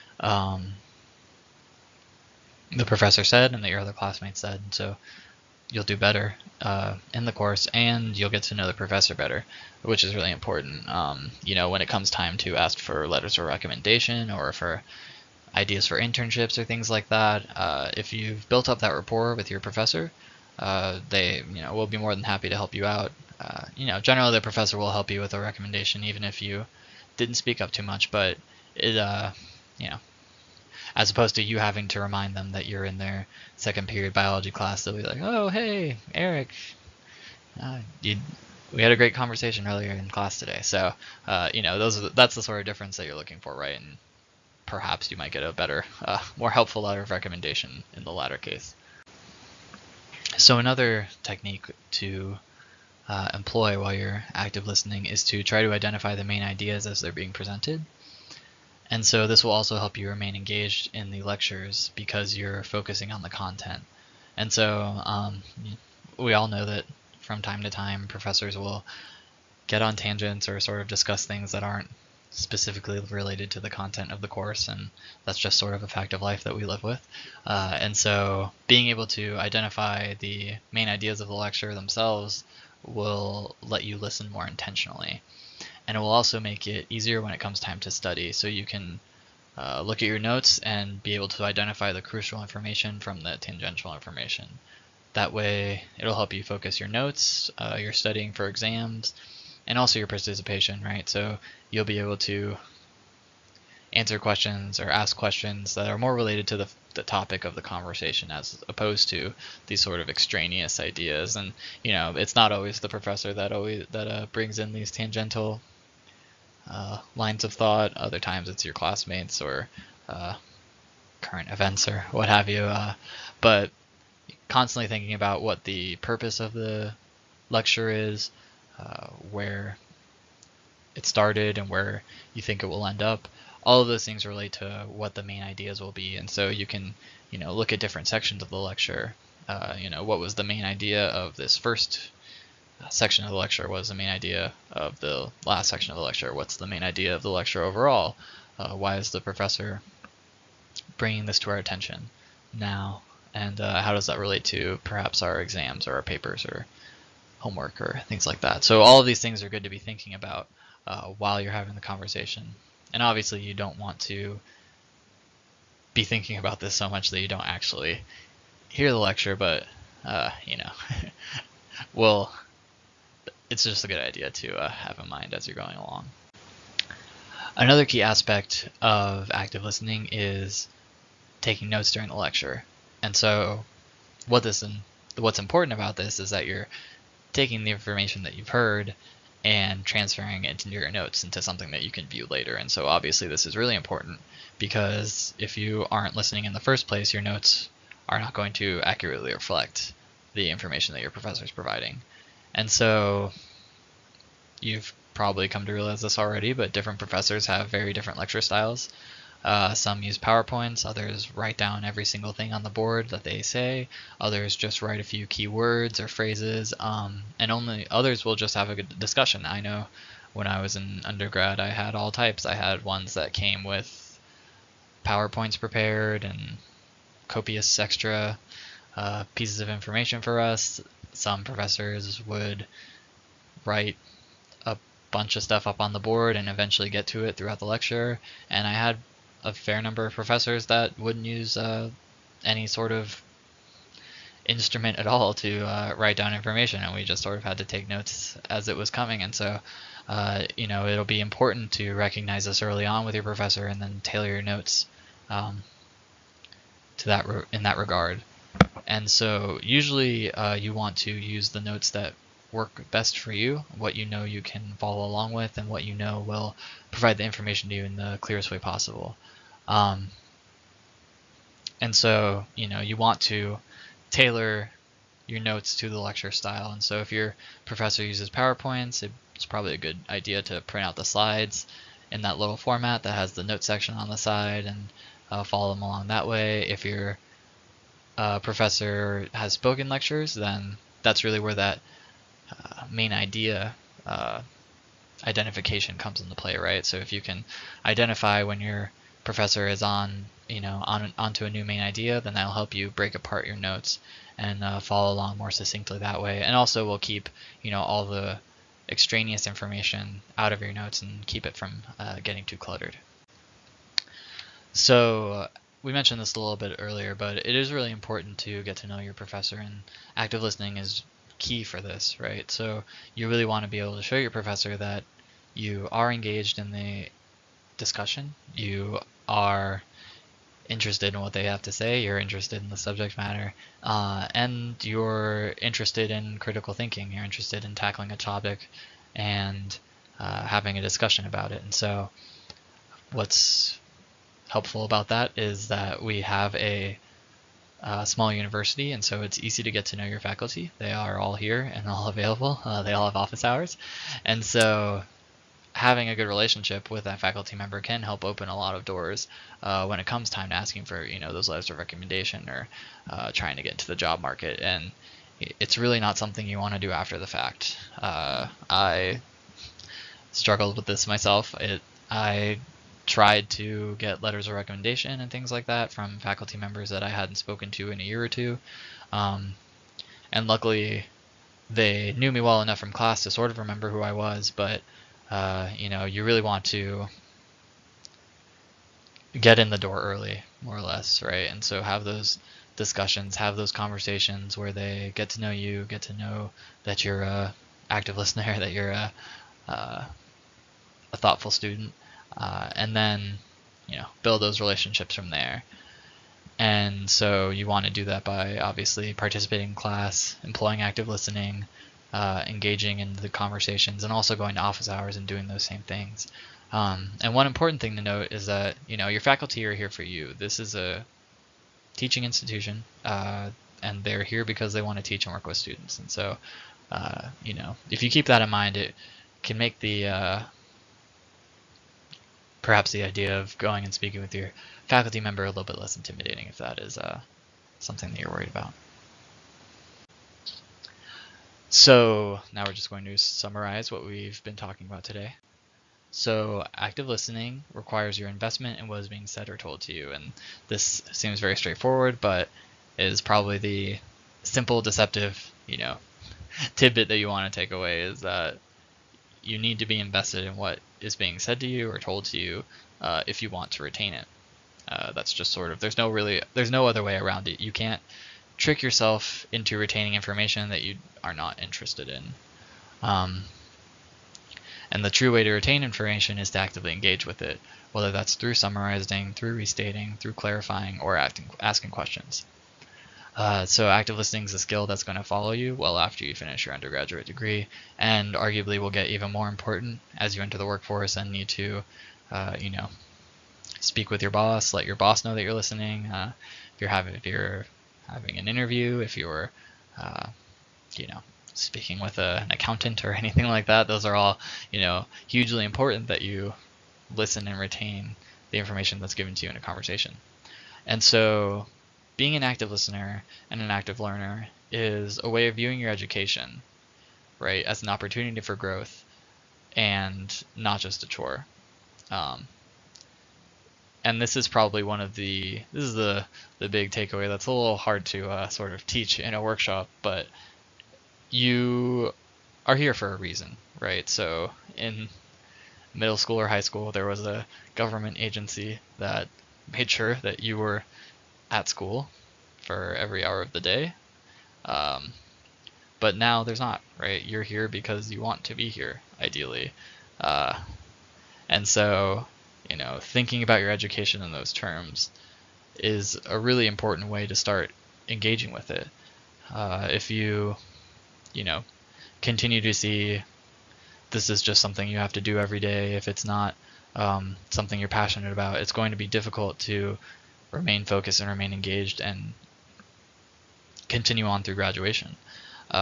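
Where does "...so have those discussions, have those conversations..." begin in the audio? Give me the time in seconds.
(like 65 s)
391 s.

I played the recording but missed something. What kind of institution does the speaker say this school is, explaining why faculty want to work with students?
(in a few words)
teaching institution.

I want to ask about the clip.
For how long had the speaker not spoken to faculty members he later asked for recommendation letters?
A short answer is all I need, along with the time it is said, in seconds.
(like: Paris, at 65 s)
a year or two, at 378 s.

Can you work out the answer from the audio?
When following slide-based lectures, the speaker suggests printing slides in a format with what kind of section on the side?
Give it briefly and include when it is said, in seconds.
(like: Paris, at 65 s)
note section, at 283 s.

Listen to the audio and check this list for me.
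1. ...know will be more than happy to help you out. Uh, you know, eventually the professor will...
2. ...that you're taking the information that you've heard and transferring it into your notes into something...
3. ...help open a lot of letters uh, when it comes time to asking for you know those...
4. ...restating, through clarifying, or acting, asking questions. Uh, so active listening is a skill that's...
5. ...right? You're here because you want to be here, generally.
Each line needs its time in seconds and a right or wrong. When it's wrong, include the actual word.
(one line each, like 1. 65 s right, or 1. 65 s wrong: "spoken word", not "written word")
1. 21 s wrong: "generally", not "eventually"
2. 186 s right
3. 358 s wrong: "doors", not "letters"
4. 479 s right
5. 546 s wrong: "ideally", not "generally".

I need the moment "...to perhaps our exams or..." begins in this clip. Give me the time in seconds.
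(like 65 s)
154 s.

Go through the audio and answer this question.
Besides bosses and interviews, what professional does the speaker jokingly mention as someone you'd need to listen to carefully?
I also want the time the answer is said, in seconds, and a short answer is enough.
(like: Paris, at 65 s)
accountant, at 502 s.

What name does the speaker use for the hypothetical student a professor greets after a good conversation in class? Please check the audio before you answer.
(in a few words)
Eric.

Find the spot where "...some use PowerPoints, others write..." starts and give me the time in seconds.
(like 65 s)
209 s.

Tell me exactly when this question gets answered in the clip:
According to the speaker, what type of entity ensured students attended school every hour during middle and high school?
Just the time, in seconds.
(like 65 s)
537 s.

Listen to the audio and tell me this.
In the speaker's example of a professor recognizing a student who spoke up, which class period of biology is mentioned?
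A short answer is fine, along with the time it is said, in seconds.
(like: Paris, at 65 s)
second period, at 33 s.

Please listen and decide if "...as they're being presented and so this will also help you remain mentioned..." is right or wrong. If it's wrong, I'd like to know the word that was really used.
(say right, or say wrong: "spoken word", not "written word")
wrong: "engaged", not "mentioned".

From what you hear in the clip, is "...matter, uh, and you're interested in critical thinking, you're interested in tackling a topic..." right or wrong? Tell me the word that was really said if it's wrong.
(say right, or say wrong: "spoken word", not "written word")
right.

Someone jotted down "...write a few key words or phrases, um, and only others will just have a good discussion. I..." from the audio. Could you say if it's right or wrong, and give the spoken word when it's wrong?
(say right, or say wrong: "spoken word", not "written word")
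right.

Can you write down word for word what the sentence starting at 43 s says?
And perhaps you might get a better, uh, more helpful letter of recommendation in the latter case.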